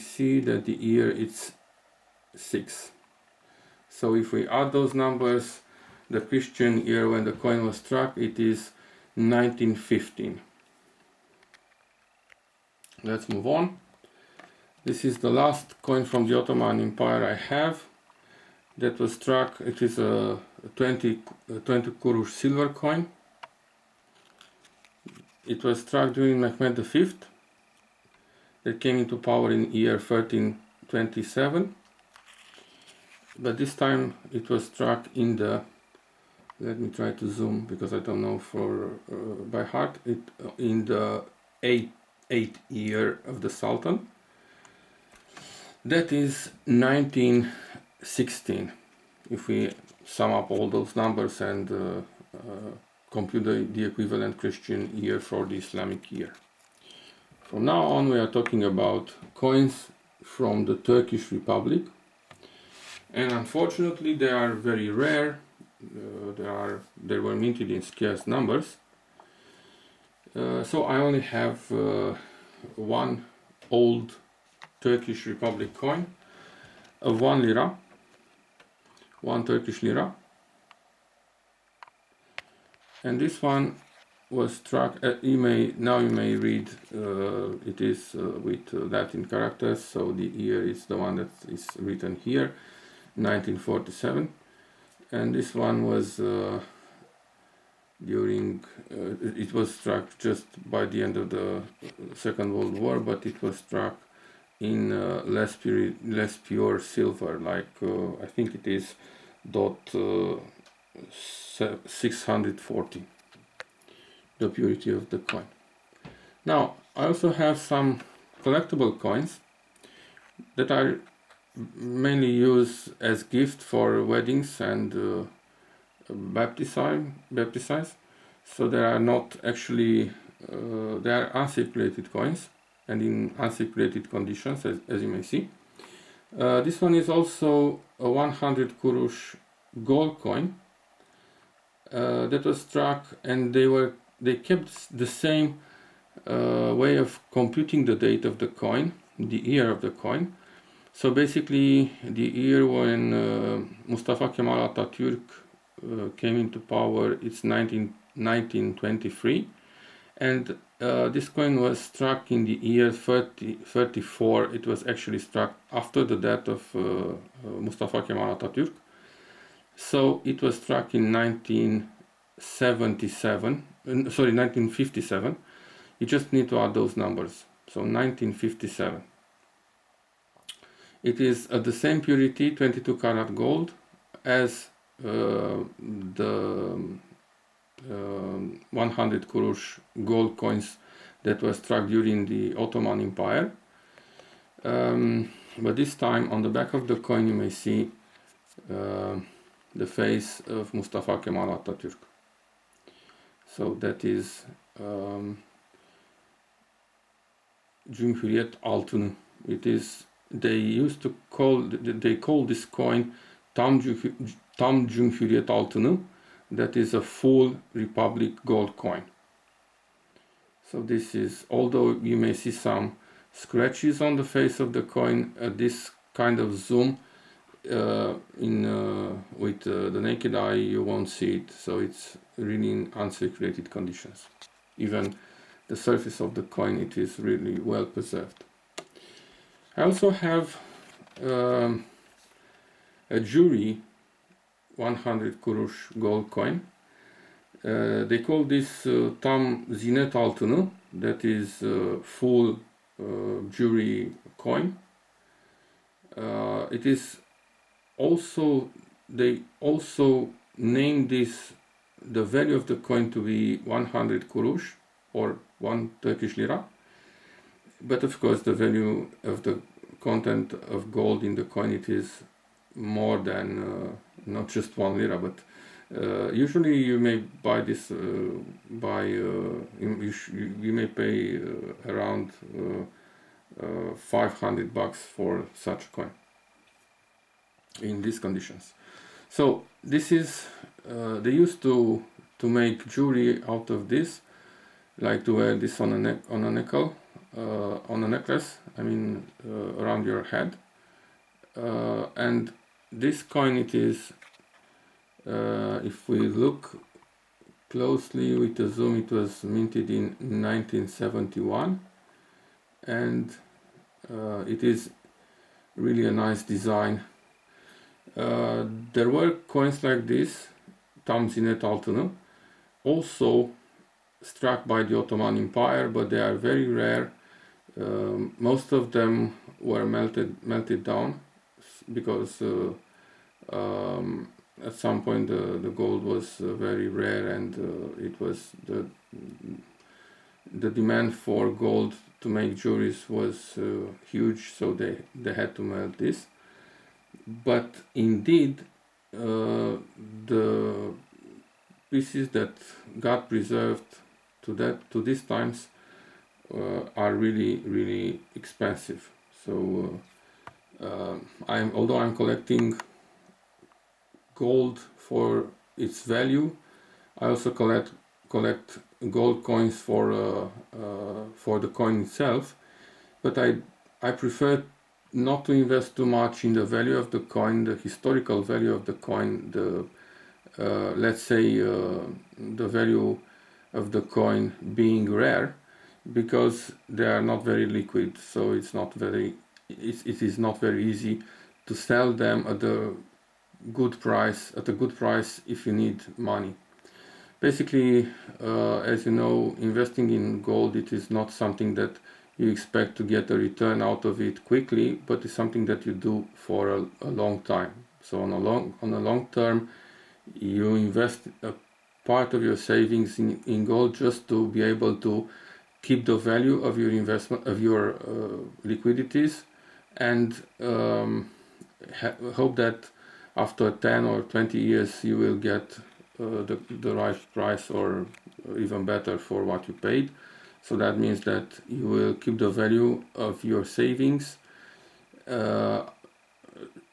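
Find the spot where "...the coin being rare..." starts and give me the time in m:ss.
6:23.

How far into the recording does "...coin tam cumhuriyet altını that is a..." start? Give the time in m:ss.
3:32.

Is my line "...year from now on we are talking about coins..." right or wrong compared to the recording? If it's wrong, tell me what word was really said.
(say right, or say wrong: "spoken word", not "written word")
right.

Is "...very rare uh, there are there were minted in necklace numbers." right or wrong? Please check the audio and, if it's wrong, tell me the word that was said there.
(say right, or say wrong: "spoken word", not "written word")
wrong: "scarce", not "necklace".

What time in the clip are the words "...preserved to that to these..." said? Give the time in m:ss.
5:53.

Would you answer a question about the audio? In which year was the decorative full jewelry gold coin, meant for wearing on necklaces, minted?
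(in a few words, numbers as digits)
1971.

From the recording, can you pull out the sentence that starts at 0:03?
So if we add those numbers, the Christian year when the coin was struck, it is 1915.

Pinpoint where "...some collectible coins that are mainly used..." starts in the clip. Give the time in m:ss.
1:57.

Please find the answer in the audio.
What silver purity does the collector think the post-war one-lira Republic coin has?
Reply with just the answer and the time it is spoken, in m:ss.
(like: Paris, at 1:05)
0.640, at 1:51.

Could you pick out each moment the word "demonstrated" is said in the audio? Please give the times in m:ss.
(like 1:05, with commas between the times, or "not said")
not said.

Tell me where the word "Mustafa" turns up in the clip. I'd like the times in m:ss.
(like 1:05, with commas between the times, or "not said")
2:33, 2:47, 3:20.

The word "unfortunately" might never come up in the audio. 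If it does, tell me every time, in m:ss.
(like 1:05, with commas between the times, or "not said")
1:03.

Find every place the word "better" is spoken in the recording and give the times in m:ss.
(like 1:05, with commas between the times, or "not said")
7:08.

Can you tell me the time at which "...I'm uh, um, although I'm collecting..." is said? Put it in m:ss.
6:00.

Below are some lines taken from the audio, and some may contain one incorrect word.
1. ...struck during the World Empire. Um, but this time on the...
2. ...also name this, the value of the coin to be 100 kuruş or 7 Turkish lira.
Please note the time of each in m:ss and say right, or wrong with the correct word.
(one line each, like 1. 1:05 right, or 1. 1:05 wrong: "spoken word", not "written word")
1. 3:11 wrong: "Ottoman", not "World"
2. 4:19 wrong: "1", not "7".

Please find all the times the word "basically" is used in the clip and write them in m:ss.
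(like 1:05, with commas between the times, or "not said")
2:31, 6:37.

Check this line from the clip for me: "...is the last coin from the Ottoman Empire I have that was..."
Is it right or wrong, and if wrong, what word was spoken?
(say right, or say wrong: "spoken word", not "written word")
right.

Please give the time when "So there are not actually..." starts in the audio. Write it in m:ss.
2:08.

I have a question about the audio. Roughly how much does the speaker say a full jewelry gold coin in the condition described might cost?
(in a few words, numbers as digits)
$500.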